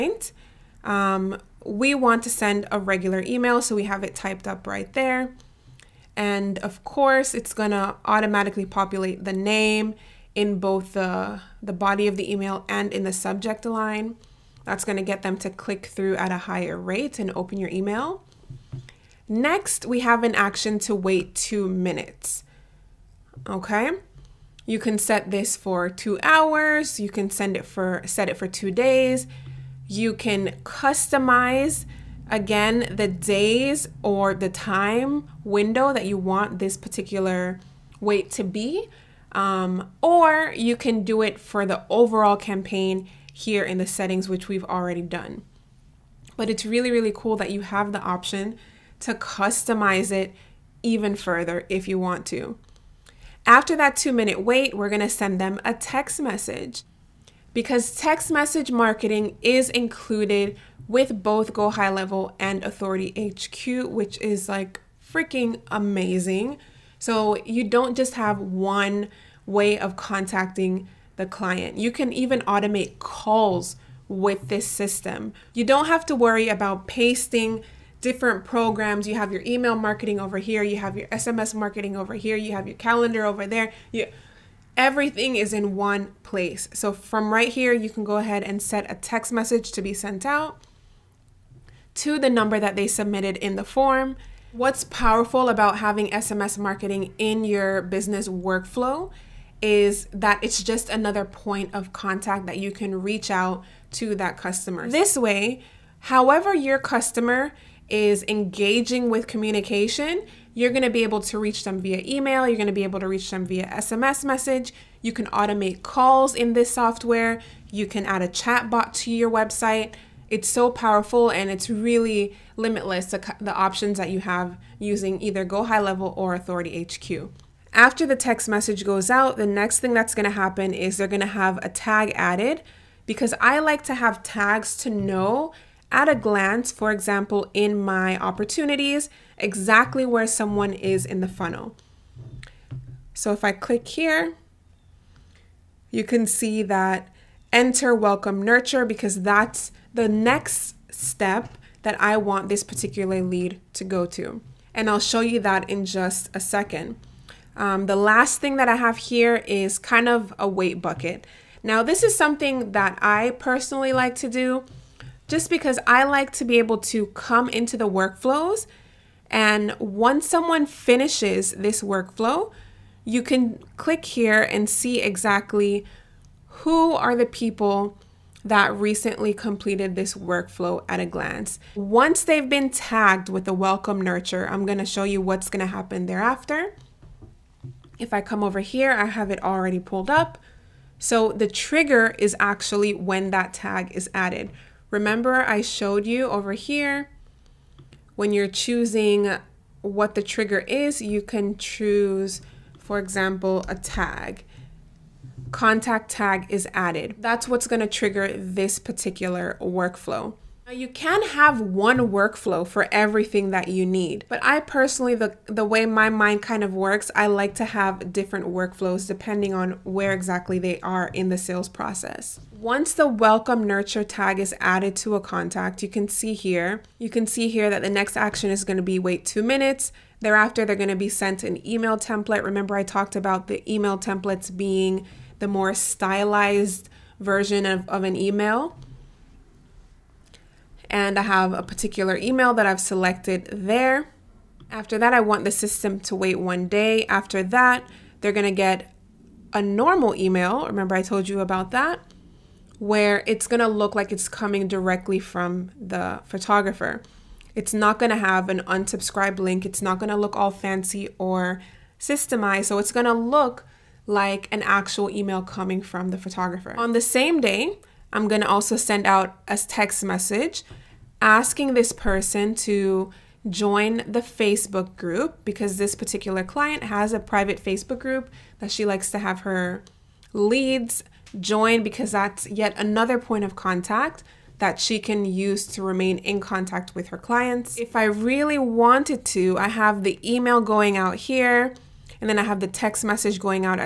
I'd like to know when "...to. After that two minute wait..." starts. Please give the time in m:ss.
0:52.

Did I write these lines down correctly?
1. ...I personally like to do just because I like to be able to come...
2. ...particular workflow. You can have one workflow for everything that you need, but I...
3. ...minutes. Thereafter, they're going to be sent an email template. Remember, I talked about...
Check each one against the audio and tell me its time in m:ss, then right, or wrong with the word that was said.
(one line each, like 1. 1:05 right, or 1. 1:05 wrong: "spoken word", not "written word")
1. 2:43 right
2. 3:28 right
3. 3:49 right.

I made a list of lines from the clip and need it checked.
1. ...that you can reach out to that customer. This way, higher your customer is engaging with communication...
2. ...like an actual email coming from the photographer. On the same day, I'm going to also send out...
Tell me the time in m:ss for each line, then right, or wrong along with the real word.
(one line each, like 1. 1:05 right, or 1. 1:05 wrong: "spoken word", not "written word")
1. 1:42 wrong: "however", not "higher"
2. 4:24 right.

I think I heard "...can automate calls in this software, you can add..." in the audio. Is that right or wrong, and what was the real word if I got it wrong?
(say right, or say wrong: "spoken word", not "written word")
right.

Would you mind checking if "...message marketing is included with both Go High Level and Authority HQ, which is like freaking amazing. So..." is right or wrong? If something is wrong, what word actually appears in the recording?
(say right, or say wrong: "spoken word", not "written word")
right.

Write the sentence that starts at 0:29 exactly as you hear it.
You can customize again the days or the time window that you want this particular wait to be.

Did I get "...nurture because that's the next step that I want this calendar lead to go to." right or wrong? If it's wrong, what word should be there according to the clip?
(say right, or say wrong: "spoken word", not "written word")
wrong: "particular", not "calendar".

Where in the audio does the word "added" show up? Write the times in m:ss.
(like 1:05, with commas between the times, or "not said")
2:12, 3:14, 3:26, 3:44.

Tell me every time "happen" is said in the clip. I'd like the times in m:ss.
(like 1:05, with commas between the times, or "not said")
2:10, 3:05.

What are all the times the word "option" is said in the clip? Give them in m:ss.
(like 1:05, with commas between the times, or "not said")
0:48, 2:03.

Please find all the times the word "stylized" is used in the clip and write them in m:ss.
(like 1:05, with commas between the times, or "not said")
3:55.